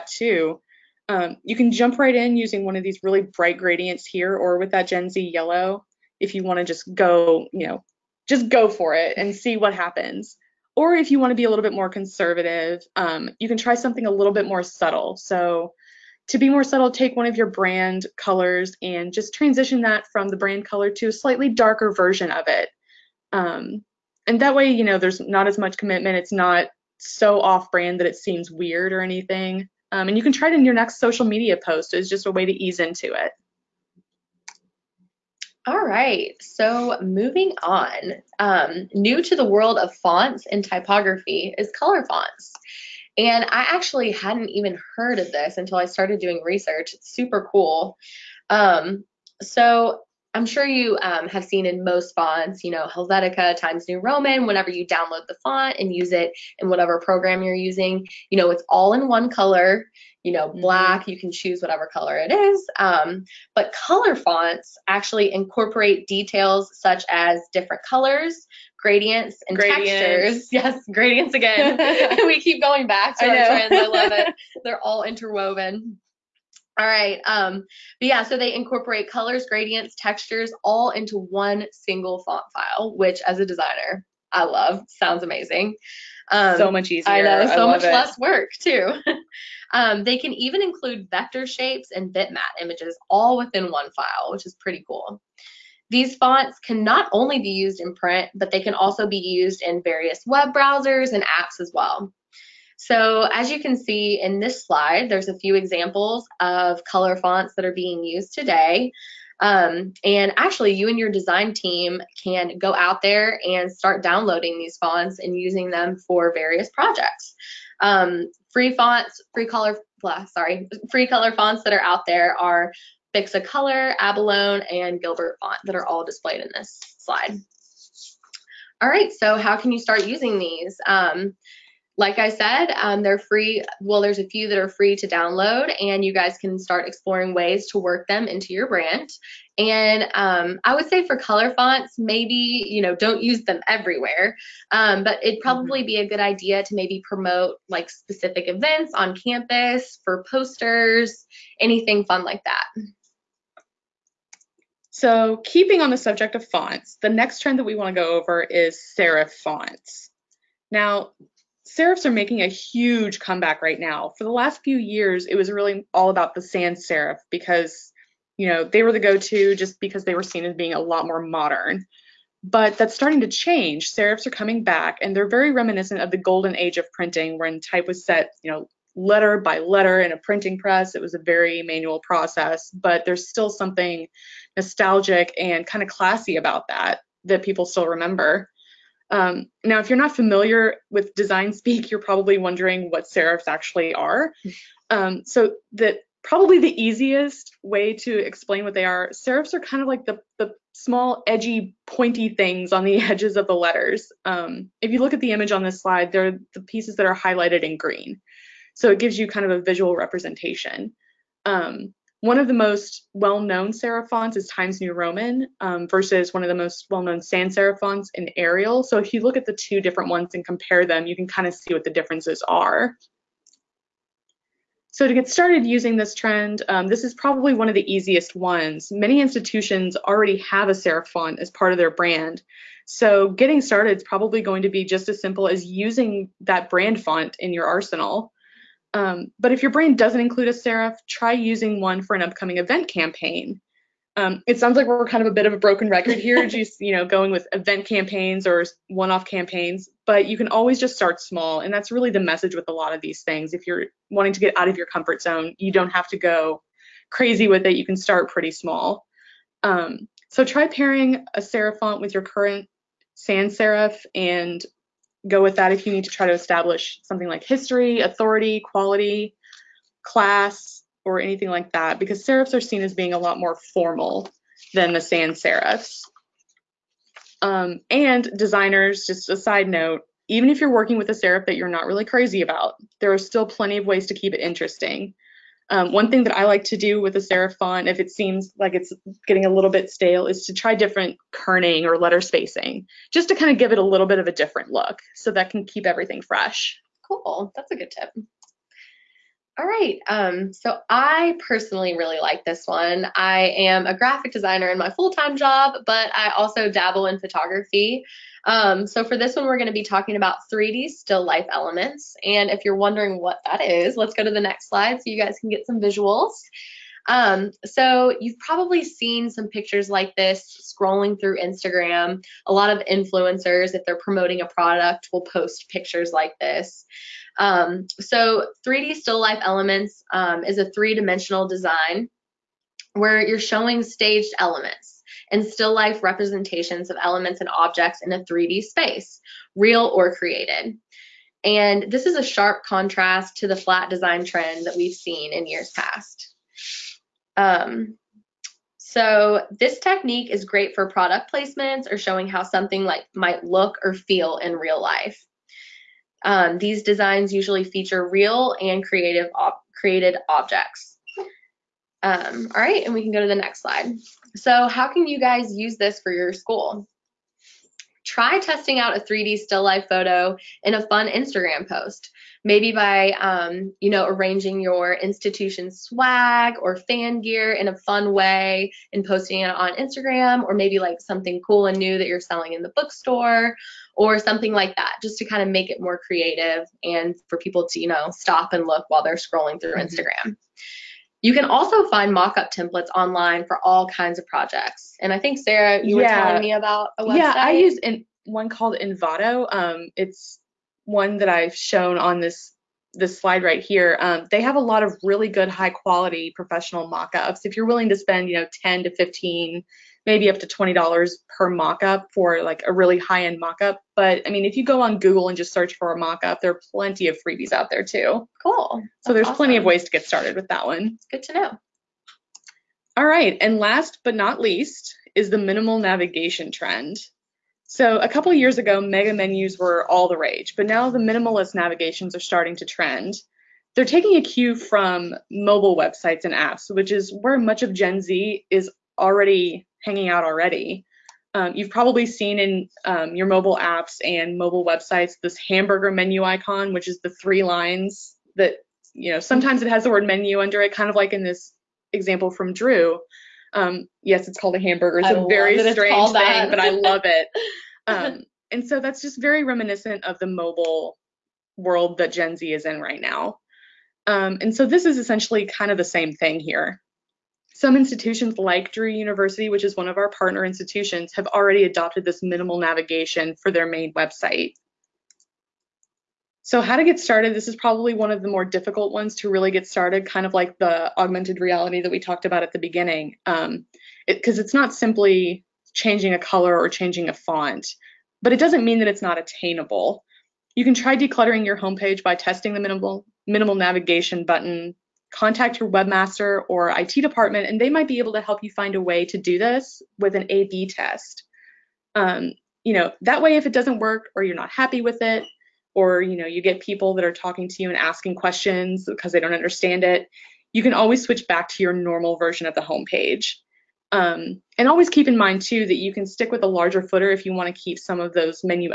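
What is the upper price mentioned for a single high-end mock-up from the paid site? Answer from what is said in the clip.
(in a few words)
$20.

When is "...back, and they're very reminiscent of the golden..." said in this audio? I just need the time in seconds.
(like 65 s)
174 s.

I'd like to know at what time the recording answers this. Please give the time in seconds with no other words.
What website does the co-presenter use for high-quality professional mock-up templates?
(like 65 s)
398 s.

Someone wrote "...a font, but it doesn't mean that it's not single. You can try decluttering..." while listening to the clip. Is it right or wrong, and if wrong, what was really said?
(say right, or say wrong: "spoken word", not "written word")
wrong: "attainable", not "single".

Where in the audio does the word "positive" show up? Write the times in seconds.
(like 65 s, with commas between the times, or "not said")
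not said.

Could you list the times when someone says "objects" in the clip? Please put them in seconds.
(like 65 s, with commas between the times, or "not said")
337 s, 360 s.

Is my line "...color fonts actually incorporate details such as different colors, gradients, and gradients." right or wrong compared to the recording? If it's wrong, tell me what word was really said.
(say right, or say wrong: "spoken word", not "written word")
right.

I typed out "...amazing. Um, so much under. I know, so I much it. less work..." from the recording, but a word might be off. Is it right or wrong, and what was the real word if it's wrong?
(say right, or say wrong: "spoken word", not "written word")
wrong: "easier", not "under".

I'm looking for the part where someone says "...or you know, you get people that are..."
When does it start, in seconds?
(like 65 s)
505 s.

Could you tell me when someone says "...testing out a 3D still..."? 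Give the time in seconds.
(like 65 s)
368 s.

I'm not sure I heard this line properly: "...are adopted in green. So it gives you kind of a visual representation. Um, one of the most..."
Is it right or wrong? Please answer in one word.
wrong.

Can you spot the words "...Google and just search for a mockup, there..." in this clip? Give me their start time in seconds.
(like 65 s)
414 s.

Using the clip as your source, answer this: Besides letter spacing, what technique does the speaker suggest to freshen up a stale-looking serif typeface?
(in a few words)
kerning.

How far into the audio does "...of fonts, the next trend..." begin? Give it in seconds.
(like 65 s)
156 s.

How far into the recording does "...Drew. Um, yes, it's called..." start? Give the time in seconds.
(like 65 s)
452 s.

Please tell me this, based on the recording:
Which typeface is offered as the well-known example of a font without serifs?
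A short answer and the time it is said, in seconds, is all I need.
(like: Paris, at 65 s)
Arial, at 218 s.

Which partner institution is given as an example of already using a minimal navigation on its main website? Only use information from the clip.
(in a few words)
Drew University.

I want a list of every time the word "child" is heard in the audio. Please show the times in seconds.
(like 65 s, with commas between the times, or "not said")
not said.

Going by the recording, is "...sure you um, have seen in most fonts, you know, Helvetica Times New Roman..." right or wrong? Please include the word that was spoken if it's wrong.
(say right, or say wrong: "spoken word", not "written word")
right.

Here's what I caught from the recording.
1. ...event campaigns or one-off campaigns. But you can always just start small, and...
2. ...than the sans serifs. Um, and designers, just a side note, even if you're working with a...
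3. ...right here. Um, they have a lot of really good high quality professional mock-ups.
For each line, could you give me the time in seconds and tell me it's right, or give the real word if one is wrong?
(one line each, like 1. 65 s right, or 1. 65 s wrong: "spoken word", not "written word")
1. 247 s right
2. 274 s right
3. 403 s right.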